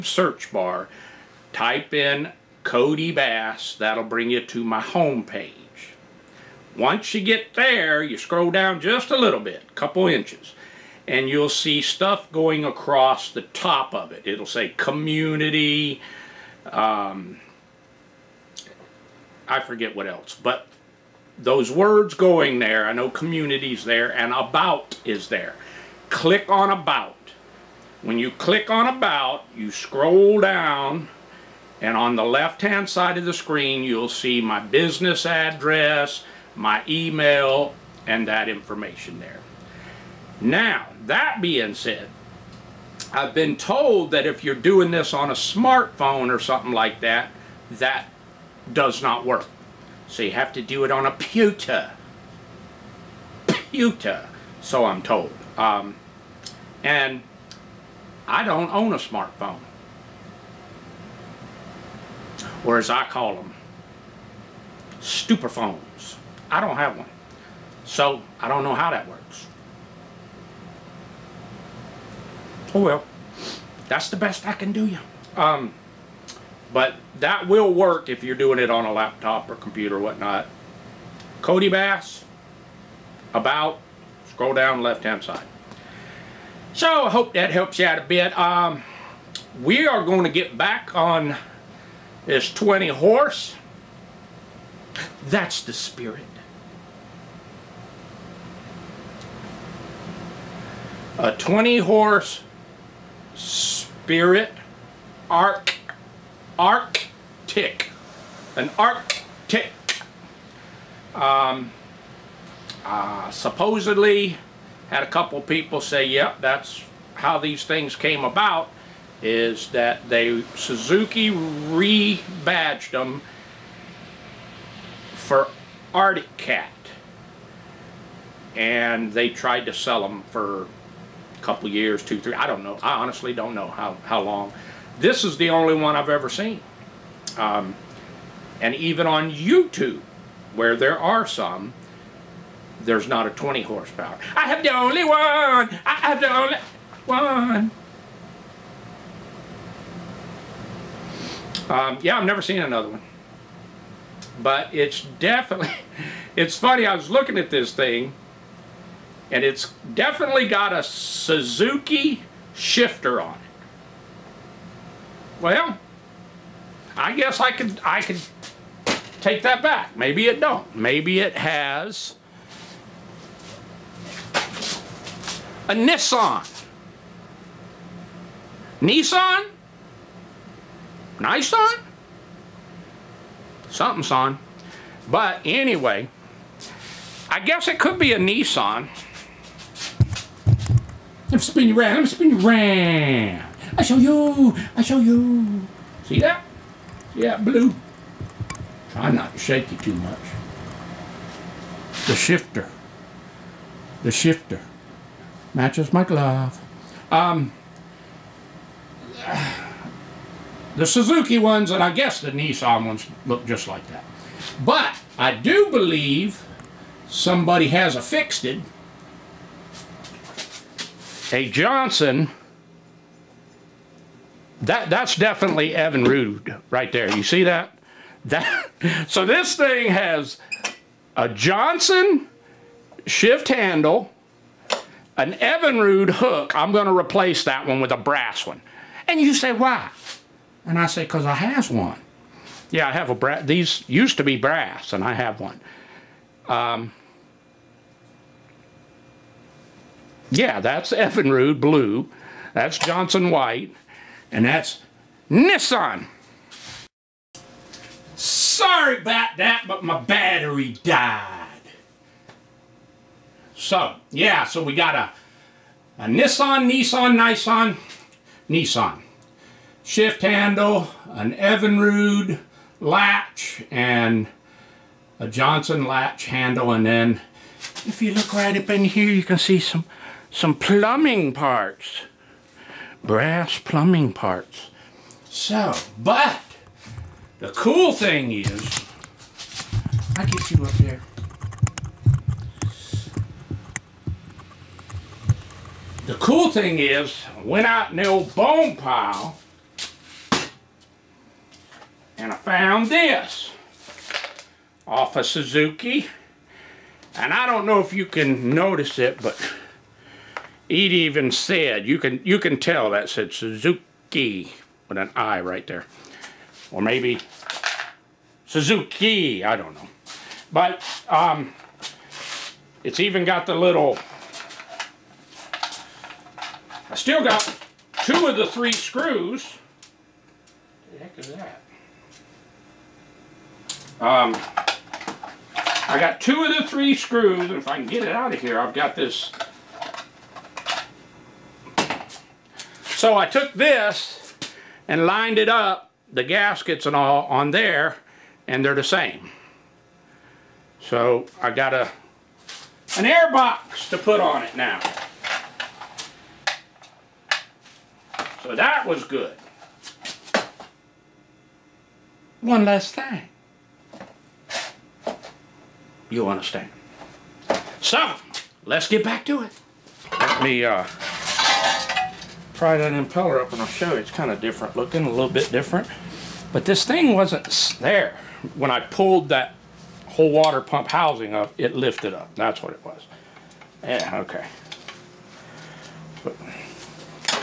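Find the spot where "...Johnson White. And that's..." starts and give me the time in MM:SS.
04:12.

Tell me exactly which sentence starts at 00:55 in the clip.
Um, and I don't own a smartphone.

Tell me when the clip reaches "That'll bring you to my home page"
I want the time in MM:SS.
00:03.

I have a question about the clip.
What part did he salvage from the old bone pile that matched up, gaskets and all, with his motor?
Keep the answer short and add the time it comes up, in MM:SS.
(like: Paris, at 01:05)
An air box, at 05:53.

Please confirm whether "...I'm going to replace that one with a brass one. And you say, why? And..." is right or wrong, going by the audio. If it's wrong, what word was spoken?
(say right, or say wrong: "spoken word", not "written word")
right.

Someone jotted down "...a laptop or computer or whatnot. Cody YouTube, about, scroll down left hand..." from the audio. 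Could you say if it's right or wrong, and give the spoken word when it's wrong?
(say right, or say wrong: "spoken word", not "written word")
wrong: "Bass", not "YouTube".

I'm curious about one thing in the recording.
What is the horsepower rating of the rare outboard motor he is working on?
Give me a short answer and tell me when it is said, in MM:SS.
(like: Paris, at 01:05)
20, at 02:23.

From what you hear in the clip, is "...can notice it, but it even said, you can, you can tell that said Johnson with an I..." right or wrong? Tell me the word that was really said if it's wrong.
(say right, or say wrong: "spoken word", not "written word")
wrong: "Suzuki", not "Johnson".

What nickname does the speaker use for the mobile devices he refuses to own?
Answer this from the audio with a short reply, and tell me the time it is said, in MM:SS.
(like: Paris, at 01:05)
Stupophones, at 01:05.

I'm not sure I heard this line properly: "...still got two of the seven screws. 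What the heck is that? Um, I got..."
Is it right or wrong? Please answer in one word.
wrong.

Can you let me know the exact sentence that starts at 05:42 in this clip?
So I took this and lined it up, the gaskets and all, on there, and they're the same.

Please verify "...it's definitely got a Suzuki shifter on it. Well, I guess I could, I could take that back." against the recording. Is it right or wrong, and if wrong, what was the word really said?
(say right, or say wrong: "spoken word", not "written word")
right.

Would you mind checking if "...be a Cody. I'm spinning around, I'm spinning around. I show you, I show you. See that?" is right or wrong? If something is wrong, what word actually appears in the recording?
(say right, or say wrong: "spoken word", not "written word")
wrong: "Nissan", not "Cody".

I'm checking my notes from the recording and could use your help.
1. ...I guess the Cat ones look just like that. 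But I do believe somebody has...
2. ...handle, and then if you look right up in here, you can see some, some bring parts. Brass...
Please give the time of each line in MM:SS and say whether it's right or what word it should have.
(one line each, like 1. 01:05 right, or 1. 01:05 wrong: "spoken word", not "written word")
1. 03:31 wrong: "Nissan", not "Cat"
2. 04:36 wrong: "plumbing", not "bring".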